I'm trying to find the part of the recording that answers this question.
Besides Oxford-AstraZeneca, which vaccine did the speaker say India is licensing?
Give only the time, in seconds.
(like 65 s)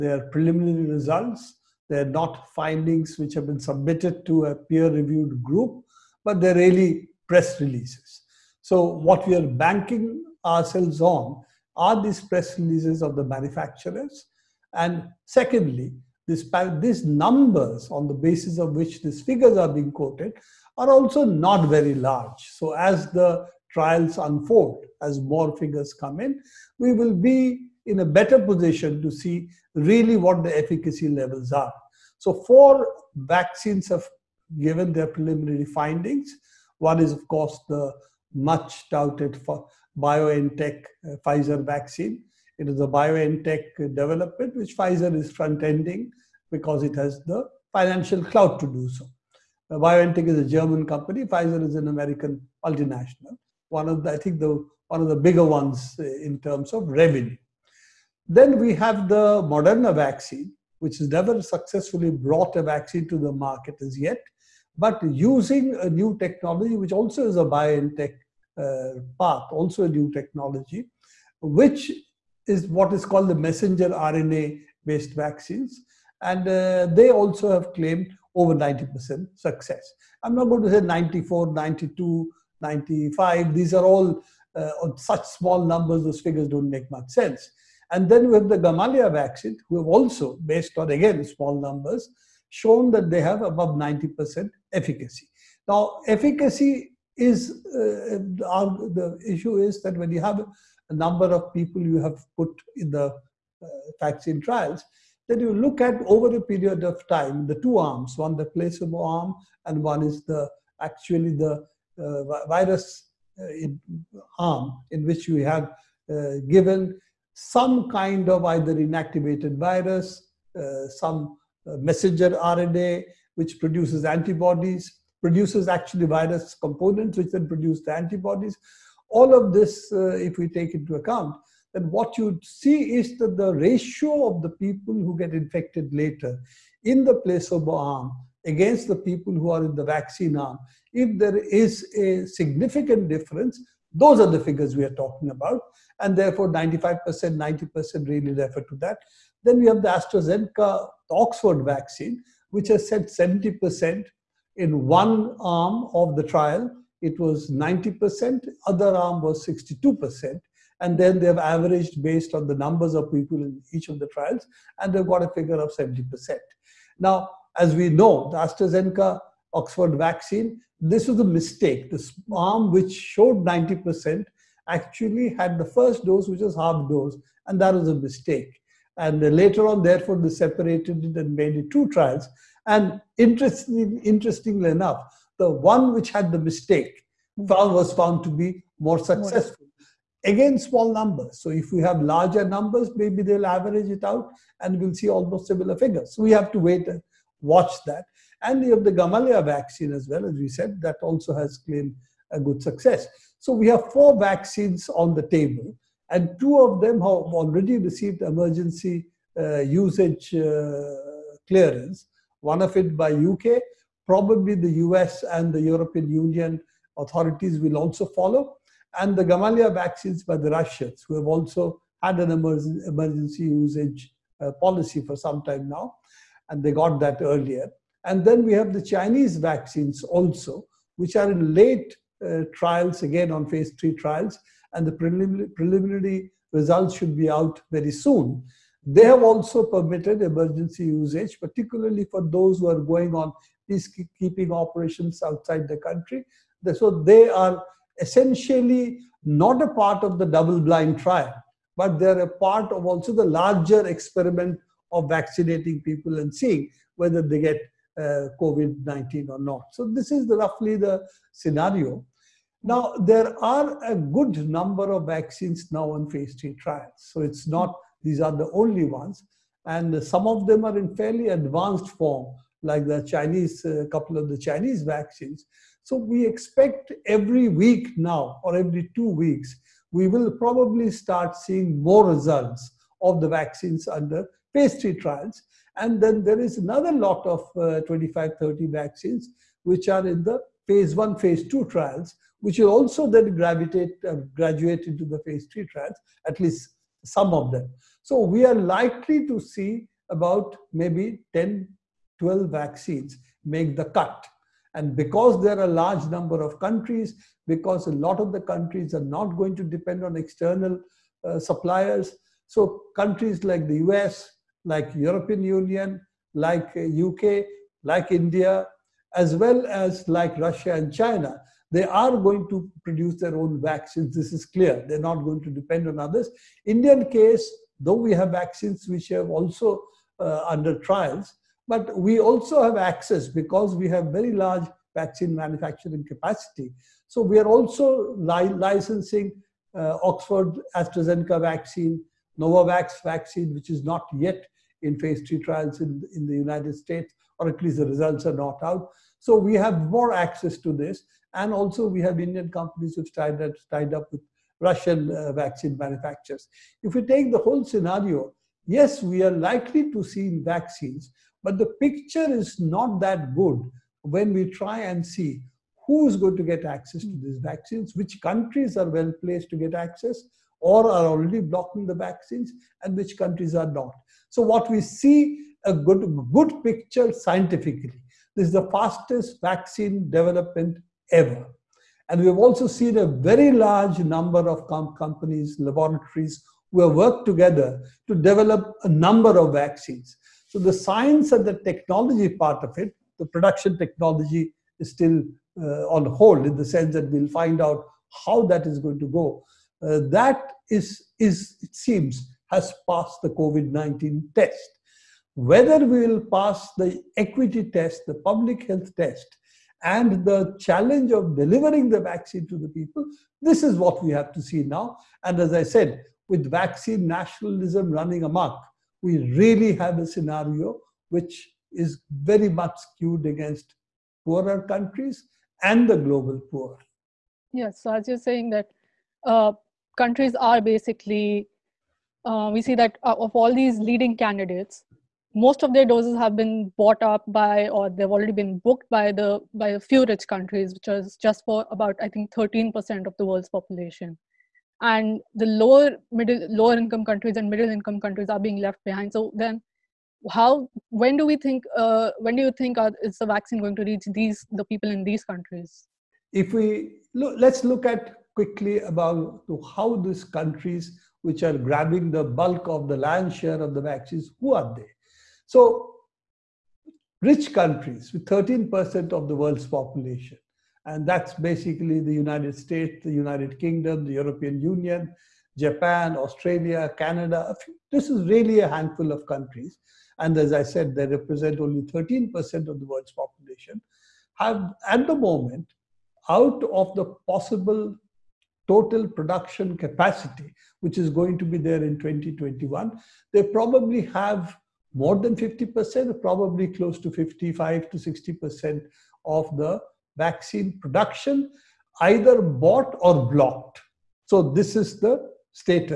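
342 s.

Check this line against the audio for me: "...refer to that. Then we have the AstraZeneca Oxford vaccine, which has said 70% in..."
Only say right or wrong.
right.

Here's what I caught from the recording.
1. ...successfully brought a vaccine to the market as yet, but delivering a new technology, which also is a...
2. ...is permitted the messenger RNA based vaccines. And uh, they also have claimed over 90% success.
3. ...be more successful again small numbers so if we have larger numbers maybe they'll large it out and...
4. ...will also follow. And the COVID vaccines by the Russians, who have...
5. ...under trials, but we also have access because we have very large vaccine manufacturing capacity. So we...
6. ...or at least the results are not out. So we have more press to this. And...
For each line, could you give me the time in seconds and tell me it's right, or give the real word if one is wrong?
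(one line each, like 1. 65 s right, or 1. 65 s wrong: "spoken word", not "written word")
1. 61 s wrong: "using", not "delivering"
2. 72 s wrong: "called", not "permitted"
3. 188 s wrong: "average", not "large"
4. 217 s wrong: "Gamaleya", not "COVID"
5. 330 s right
6. 347 s wrong: "access", not "press".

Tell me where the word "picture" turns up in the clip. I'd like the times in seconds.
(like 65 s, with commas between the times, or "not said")
361 s, 376 s.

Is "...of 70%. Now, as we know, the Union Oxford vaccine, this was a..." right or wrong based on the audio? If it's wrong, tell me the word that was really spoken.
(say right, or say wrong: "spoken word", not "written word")
wrong: "AstraZeneca", not "Union".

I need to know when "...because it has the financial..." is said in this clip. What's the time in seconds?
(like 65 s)
46 s.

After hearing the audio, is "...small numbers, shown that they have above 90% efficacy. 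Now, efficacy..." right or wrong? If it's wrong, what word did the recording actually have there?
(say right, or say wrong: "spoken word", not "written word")
right.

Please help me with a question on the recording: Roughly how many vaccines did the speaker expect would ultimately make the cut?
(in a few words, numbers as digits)
10 to 12.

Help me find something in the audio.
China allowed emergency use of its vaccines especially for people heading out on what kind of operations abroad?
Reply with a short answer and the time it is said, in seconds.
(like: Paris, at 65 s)
peacekeeping operations, at 243 s.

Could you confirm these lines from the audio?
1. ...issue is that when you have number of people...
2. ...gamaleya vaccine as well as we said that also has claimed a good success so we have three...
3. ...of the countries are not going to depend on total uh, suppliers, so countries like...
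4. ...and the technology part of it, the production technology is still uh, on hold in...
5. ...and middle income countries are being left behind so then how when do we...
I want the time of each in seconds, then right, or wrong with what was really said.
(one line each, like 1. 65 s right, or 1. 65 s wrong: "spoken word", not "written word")
1. 99 s right
2. 198 s wrong: "four", not "three"
3. 308 s wrong: "external", not "total"
4. 391 s right
5. 447 s right.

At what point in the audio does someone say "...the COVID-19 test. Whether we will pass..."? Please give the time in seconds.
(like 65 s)
403 s.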